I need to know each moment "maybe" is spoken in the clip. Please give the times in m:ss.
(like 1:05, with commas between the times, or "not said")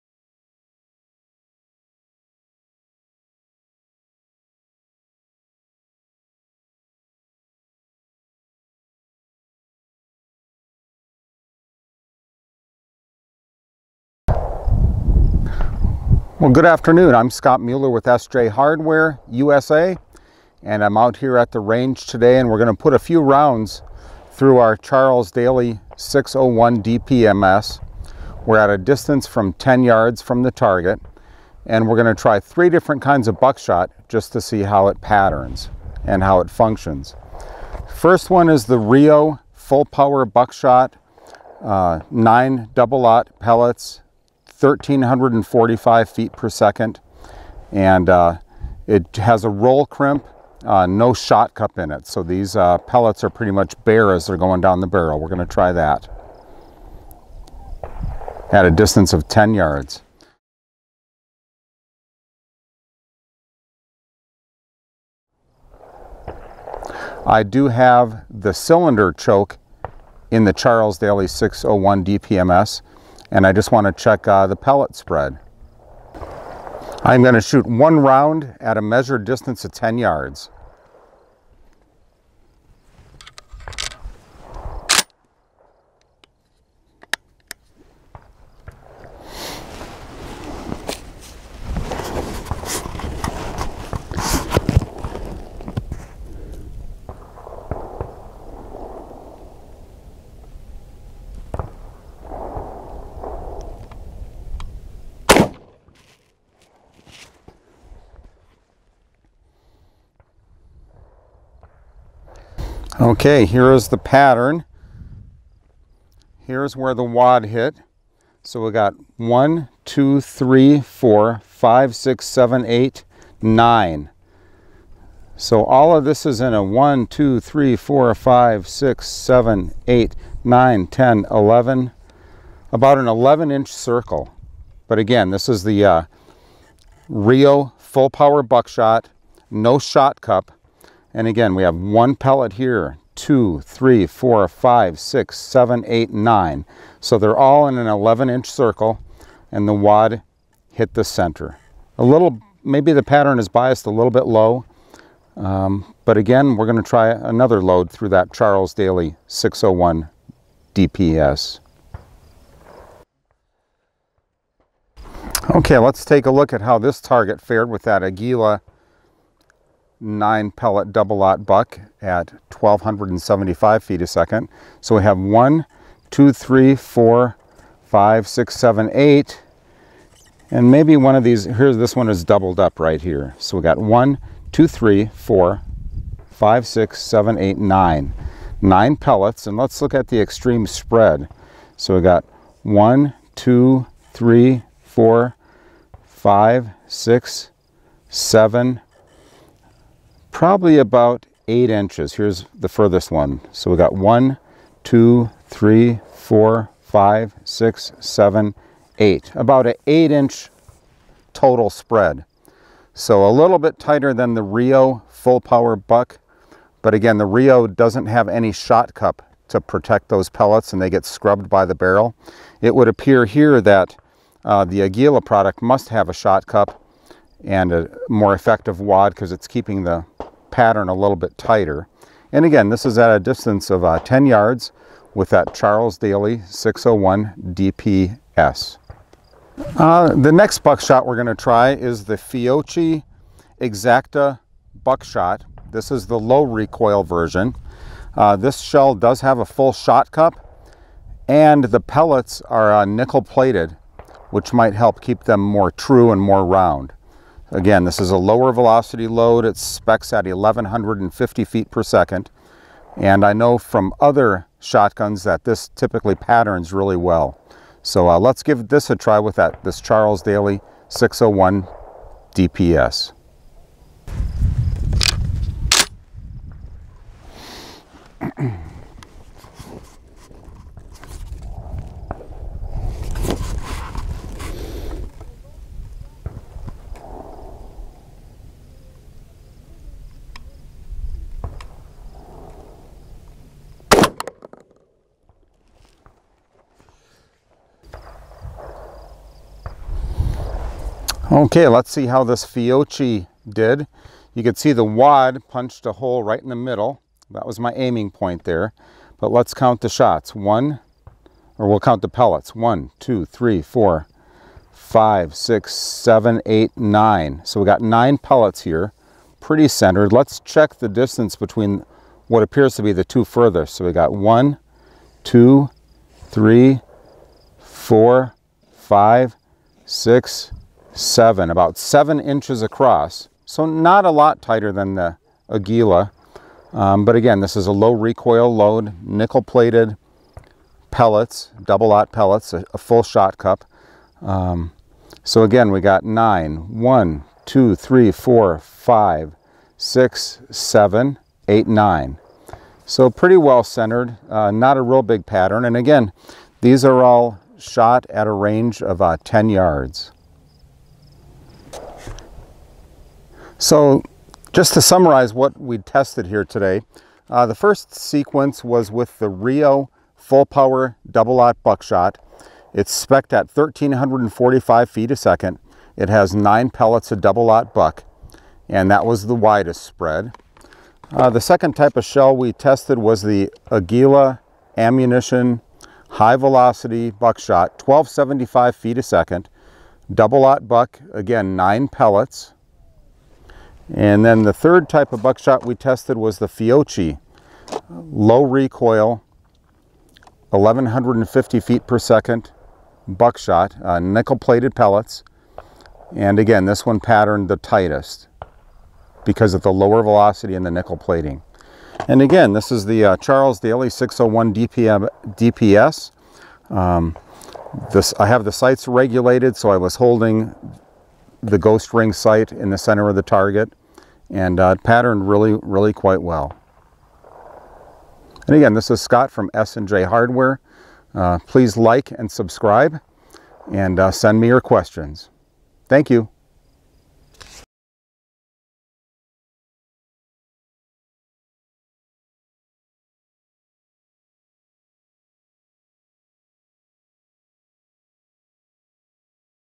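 2:32, 3:00.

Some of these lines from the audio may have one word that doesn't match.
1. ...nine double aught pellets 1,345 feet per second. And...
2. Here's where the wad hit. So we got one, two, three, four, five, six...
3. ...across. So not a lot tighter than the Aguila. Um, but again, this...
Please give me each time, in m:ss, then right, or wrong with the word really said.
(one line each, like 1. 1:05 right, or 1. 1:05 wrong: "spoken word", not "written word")
1. 0:42 right
2. 1:56 right
3. 5:32 right.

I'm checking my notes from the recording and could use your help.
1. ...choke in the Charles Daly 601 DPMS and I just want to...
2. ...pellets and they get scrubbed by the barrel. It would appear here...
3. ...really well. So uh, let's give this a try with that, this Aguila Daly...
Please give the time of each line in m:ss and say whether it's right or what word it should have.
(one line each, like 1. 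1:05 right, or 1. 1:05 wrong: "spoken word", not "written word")
1. 1:09 right
2. 3:40 right
3. 4:26 wrong: "Charles", not "Aguila".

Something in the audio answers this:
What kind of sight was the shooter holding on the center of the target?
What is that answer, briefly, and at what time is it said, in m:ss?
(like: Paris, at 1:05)
Ghost ring sight, at 7:01.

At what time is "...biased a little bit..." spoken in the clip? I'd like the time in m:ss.
2:33.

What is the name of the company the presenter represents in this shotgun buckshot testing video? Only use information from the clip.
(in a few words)
SJ Hardware USA.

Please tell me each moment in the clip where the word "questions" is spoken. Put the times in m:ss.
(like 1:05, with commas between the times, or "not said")
7:14.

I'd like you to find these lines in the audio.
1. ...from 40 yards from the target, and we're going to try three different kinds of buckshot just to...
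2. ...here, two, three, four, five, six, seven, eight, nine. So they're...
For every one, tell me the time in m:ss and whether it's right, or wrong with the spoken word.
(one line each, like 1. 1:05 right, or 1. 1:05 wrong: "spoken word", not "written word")
1. 0:29 wrong: "10", not "40"
2. 2:22 right.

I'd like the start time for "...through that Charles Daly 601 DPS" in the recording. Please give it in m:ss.
2:37.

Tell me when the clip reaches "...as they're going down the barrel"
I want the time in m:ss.
0:54.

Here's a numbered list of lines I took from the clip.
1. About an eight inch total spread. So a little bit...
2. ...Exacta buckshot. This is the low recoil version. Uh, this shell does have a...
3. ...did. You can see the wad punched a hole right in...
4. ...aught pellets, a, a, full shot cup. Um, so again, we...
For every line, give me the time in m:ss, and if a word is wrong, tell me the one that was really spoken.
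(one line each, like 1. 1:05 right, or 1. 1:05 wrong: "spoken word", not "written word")
1. 3:29 right
2. 4:03 right
3. 5:03 right
4. 5:41 right.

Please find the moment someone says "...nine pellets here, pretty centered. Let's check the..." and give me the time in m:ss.
5:17.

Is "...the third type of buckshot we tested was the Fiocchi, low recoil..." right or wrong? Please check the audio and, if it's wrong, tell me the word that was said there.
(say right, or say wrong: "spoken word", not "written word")
right.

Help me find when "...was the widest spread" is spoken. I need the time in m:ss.
6:19.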